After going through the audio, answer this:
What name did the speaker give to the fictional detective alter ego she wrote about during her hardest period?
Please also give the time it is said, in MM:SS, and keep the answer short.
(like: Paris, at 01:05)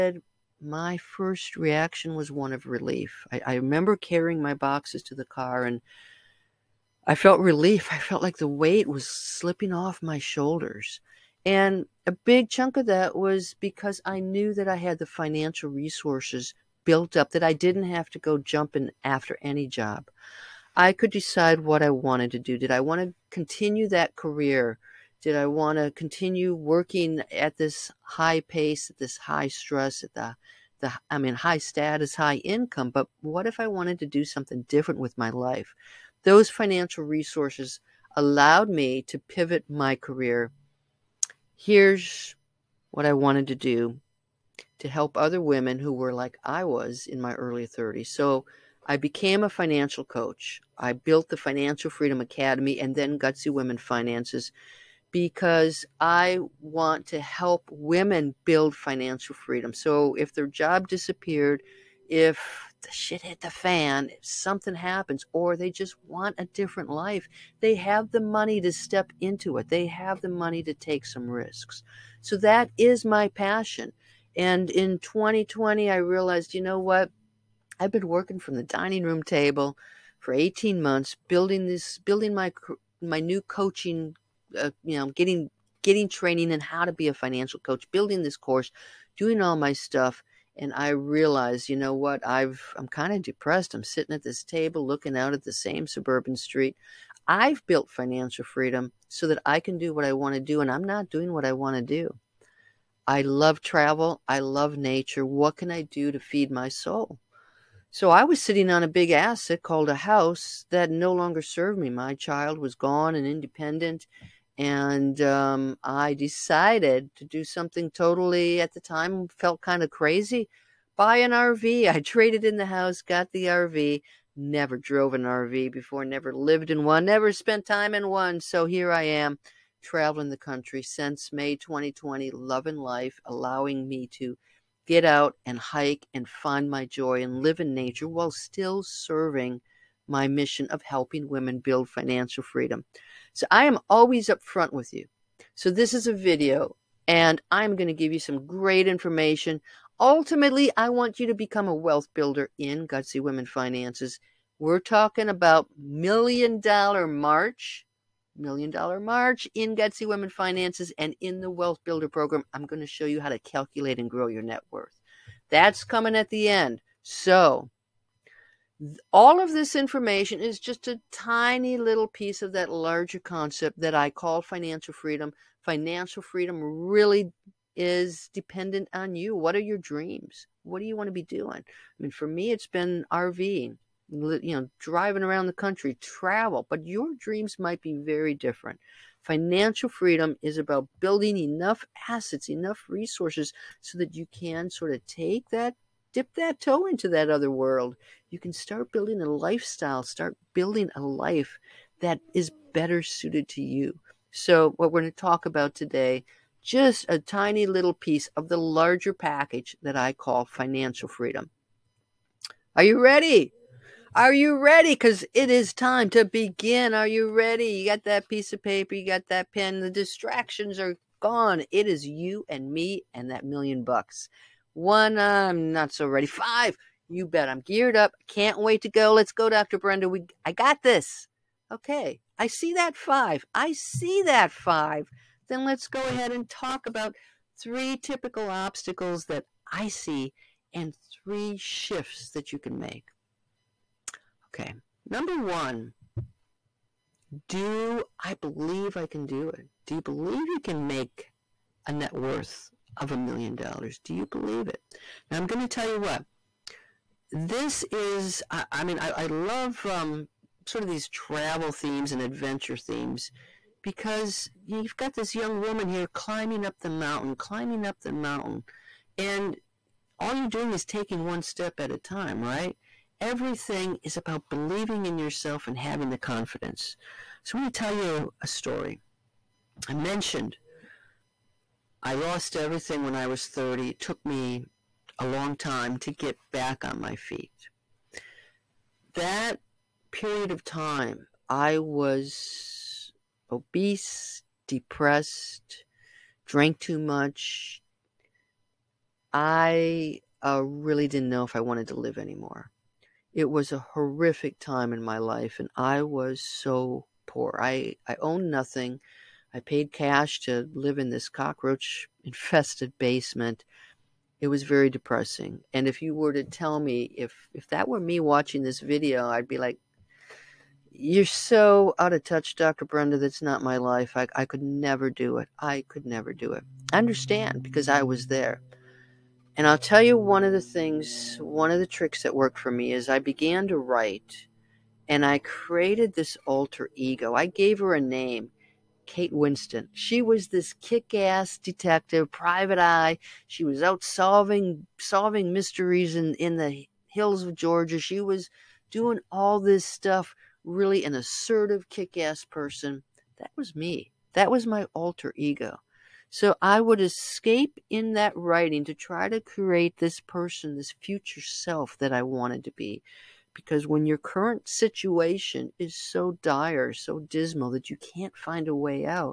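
Kate Winston, at 05:39.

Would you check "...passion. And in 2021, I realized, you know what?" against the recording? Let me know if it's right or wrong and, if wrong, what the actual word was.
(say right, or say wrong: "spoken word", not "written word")
wrong: "2020", not "2021".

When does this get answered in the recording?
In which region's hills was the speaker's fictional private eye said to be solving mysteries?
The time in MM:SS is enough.
05:47.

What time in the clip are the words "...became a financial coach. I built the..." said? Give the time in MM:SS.
00:48.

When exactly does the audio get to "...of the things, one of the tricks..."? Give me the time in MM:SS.
05:30.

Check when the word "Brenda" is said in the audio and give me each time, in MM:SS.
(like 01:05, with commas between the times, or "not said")
03:49, 05:22.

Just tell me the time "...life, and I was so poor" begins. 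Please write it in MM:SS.
05:05.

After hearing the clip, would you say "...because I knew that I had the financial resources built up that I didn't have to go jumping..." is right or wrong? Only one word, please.
right.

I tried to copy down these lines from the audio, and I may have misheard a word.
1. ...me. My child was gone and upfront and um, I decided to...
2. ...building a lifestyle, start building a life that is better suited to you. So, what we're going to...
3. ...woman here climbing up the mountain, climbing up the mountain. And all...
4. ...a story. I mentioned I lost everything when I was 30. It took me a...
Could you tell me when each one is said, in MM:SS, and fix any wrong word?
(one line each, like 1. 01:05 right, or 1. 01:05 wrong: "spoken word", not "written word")
1. 01:51 wrong: "independent", not "upfront"
2. 03:18 right
3. 04:25 right
4. 04:38 right.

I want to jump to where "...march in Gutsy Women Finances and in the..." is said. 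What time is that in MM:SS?
02:38.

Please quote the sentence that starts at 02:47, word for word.
So all of this information is just a tiny little piece of that larger concept that I call financial freedom.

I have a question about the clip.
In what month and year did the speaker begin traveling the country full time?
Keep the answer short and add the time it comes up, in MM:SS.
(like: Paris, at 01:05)
May 2020, at 02:11.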